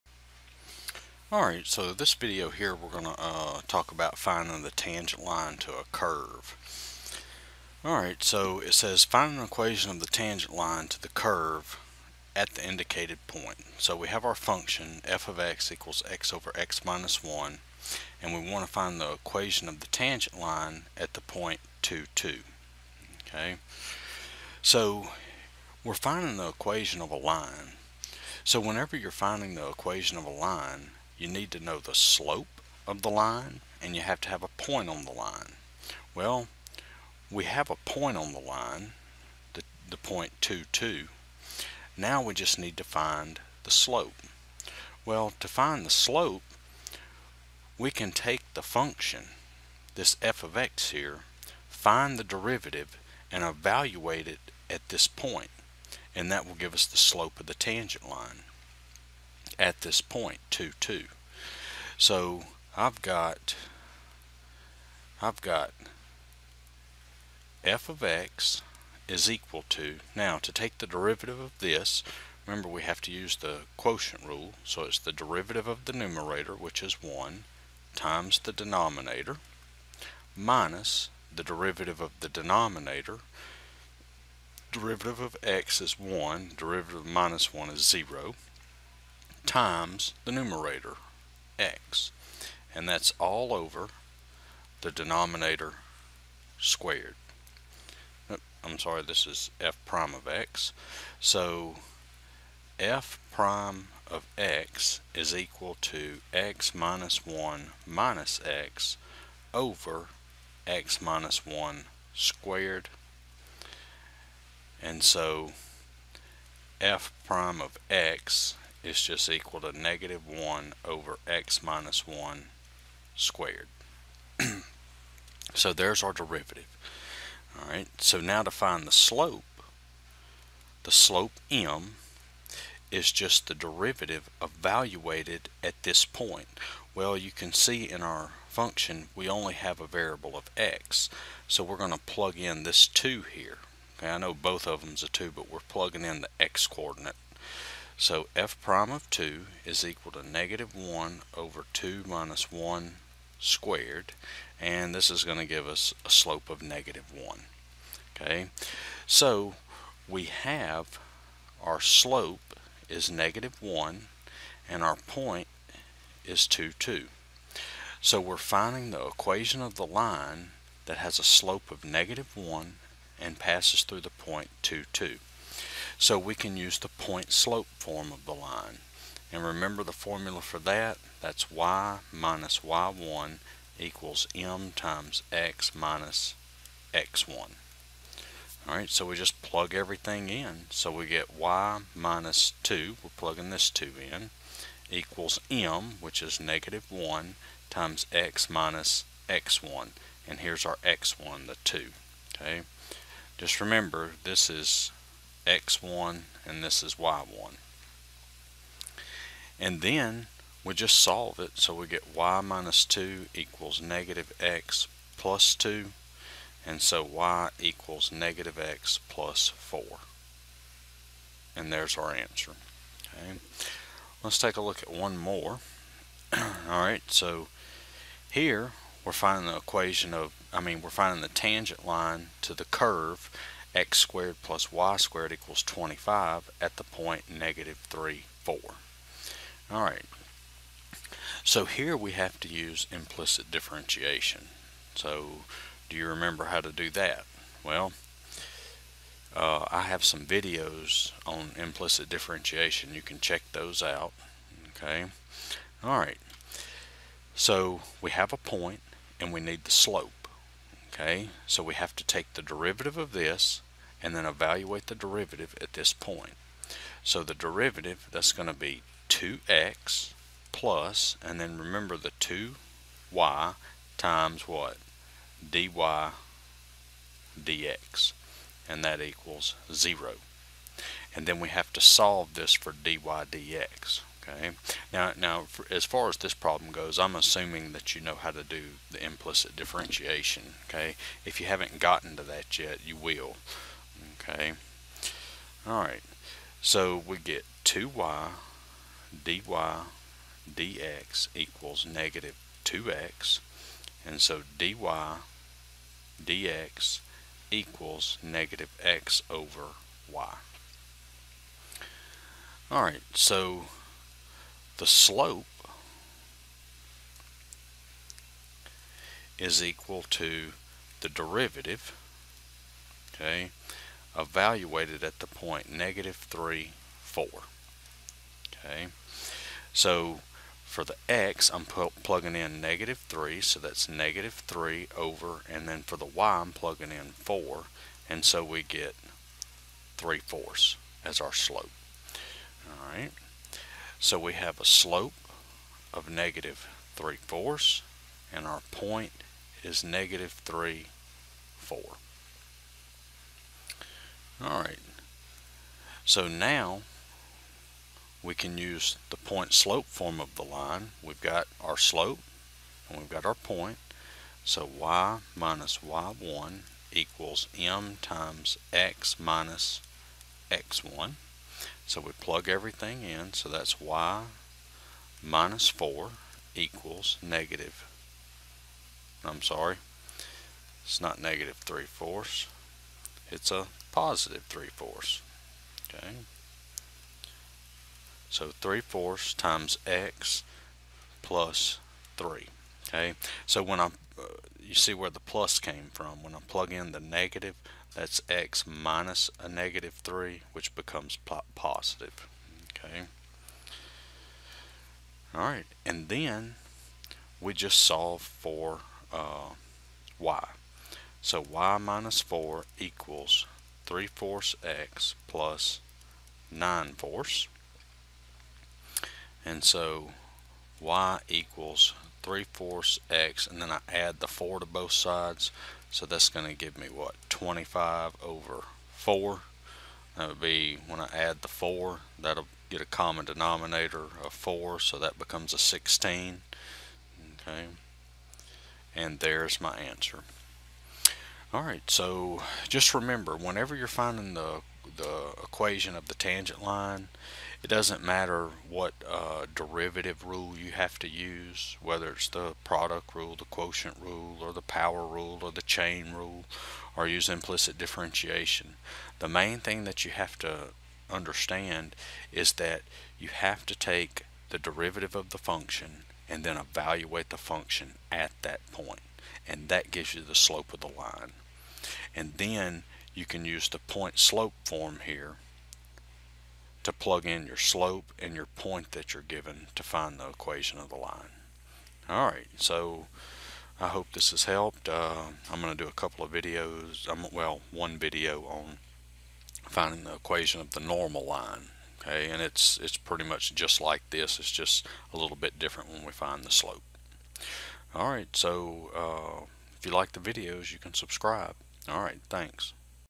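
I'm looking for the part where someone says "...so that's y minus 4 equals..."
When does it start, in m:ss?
6:13.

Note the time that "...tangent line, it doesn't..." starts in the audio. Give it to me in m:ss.
7:26.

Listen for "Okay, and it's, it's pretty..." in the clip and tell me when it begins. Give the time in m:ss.
8:12.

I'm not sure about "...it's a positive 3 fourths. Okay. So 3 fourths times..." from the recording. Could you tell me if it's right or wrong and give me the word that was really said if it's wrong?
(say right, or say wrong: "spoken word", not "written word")
right.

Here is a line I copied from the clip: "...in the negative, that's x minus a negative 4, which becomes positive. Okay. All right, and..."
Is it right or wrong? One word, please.
wrong.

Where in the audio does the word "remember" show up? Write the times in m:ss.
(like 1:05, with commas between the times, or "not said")
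1:12, 2:59, 3:23, 4:06, 4:31, 7:22.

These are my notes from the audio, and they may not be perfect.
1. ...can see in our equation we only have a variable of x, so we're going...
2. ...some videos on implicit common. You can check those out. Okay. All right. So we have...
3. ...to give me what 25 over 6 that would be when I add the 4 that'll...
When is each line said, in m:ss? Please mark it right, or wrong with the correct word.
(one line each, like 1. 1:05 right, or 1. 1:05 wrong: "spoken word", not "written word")
1. 2:17 wrong: "function", not "equation"
2. 4:10 wrong: "differentiation", not "common"
3. 7:06 wrong: "4", not "6".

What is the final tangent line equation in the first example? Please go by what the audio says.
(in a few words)
y = -x + 4.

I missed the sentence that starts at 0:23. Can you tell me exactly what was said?
Okay, so we're finding the equation of a line.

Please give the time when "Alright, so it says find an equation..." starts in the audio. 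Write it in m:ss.
0:07.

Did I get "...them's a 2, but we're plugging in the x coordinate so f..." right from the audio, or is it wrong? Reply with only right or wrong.
right.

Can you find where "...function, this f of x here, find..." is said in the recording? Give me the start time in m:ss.
0:48.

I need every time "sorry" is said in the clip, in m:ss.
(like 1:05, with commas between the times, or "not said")
1:38, 6:19.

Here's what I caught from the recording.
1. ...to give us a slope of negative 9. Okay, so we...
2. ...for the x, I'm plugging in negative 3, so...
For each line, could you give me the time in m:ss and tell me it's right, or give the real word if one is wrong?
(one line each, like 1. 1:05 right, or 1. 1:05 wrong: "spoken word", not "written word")
1. 2:35 wrong: "1", not "9"
2. 5:30 right.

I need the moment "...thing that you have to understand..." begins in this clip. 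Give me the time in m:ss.
7:39.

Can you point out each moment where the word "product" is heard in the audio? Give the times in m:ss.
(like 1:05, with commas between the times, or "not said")
7:32.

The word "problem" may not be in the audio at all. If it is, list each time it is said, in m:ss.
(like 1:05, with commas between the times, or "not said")
4:46.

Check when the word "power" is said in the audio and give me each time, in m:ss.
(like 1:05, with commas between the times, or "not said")
7:34.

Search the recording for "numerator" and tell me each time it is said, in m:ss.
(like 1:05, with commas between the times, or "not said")
1:15, 1:30.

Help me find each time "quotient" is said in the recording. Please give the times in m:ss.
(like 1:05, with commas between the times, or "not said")
1:13, 7:33.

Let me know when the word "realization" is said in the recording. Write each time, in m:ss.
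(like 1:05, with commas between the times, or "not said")
not said.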